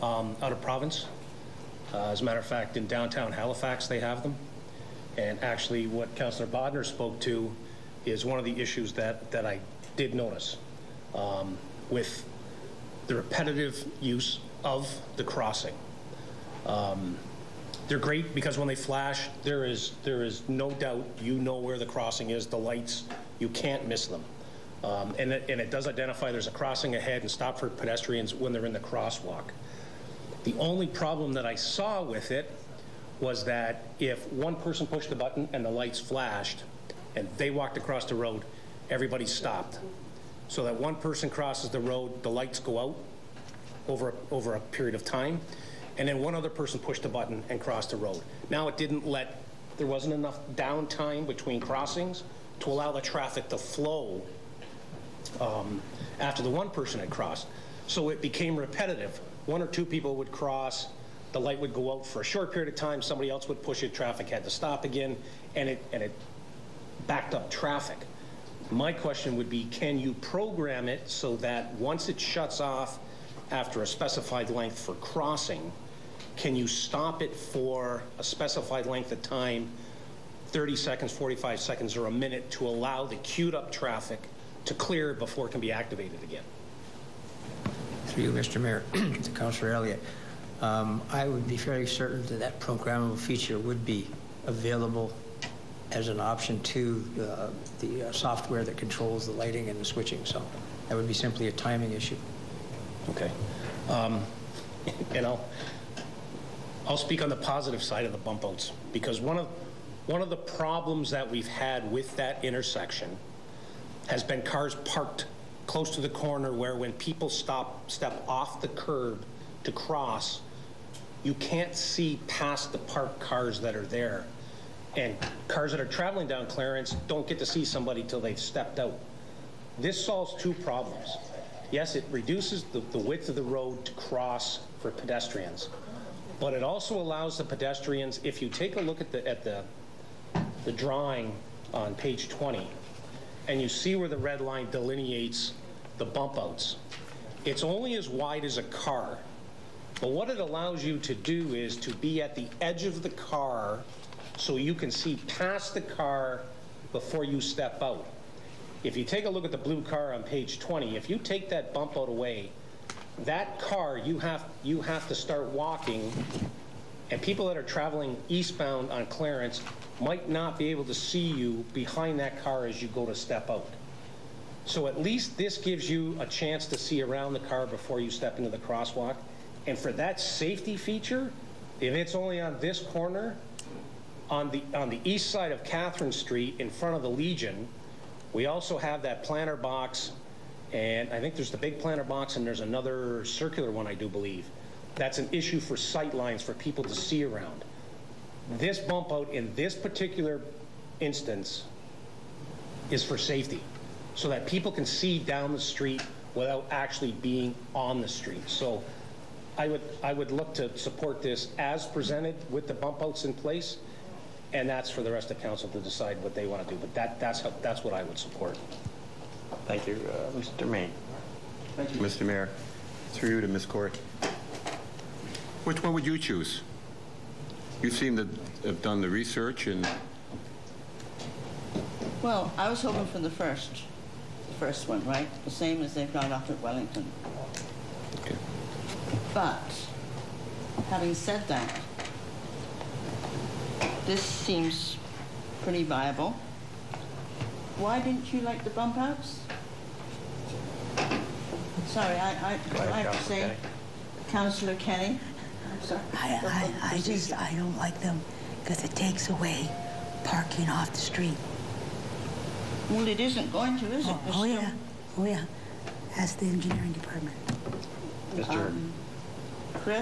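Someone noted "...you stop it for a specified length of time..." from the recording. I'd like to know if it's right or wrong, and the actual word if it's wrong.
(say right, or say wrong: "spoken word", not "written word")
right.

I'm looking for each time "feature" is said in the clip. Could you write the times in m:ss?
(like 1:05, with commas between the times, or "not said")
1:33, 3:00.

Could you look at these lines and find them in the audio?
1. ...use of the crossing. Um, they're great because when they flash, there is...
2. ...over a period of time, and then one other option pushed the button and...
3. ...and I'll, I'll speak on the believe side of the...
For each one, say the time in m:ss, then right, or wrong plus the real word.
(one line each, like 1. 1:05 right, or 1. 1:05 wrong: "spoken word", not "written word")
1. 0:13 right
2. 0:44 wrong: "person", not "option"
3. 1:45 wrong: "positive", not "believe".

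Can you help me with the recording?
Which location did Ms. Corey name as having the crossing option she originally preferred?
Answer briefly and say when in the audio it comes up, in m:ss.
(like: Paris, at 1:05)
Wellington, at 3:56.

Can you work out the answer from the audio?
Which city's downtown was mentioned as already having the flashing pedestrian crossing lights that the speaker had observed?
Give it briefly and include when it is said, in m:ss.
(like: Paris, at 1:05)
Halifax, at 0:03.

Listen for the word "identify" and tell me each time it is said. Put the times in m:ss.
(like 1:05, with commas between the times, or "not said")
0:25.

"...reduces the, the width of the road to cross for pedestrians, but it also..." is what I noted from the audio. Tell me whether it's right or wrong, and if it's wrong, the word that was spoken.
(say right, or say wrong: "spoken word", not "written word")
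right.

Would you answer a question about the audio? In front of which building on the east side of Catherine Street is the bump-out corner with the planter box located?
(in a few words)
the Legion.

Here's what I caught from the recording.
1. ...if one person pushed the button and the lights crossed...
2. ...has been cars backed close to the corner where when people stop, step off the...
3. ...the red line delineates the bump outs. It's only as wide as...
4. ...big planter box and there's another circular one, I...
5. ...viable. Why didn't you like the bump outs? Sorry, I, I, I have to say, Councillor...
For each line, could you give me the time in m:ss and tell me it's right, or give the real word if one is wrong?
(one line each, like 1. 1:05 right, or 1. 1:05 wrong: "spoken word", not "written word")
1. 0:33 wrong: "flashed", not "crossed"
2. 1:54 wrong: "parked", not "backed"
3. 2:24 right
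4. 3:11 right
5. 4:05 right.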